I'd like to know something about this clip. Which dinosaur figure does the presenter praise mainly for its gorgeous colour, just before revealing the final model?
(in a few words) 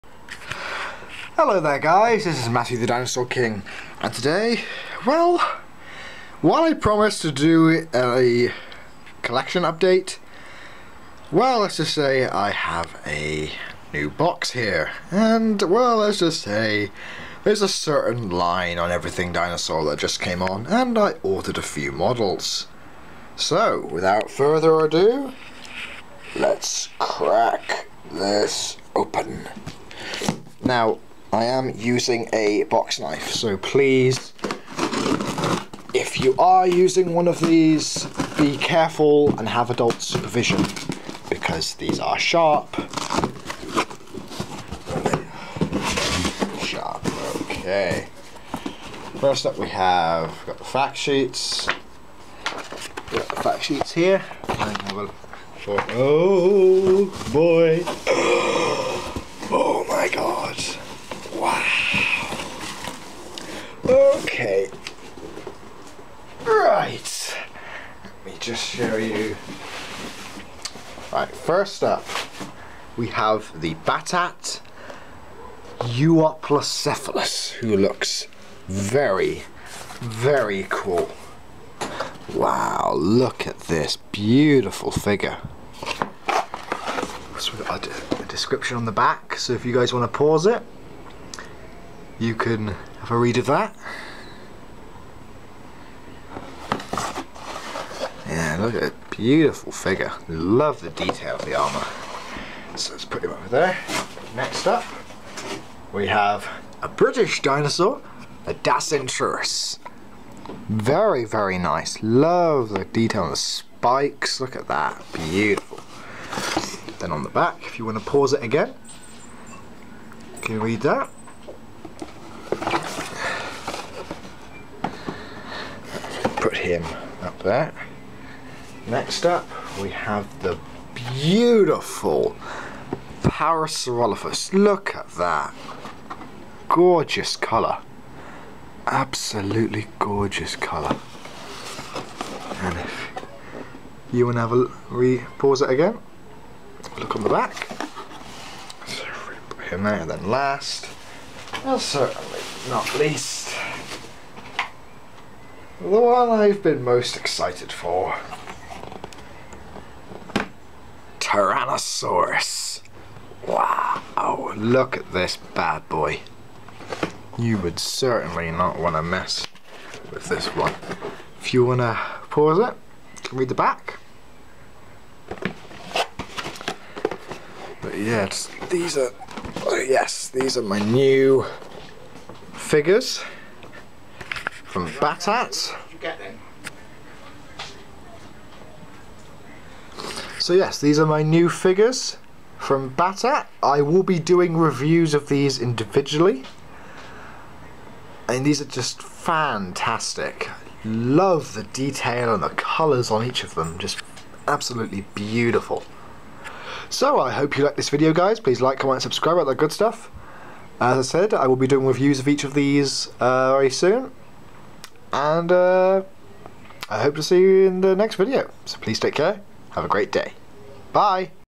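Parasaurolophus.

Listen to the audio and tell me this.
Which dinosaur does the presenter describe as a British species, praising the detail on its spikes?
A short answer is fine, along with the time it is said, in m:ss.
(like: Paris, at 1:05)
Dacentrurus, at 1:48.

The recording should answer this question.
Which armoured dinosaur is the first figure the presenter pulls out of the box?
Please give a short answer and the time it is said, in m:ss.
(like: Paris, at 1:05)
Euoplocephalus, at 1:15.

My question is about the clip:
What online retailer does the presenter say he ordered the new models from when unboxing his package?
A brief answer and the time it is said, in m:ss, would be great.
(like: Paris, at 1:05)
Everything Dinosaur, at 0:18.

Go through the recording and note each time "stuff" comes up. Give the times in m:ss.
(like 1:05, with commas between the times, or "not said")
3:29.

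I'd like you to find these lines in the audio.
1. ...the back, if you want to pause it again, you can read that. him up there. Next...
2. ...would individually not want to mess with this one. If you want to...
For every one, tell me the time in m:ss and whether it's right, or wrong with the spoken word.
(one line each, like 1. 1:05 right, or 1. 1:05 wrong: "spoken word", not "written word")
1. 1:57 right
2. 2:47 wrong: "certainly", not "individually".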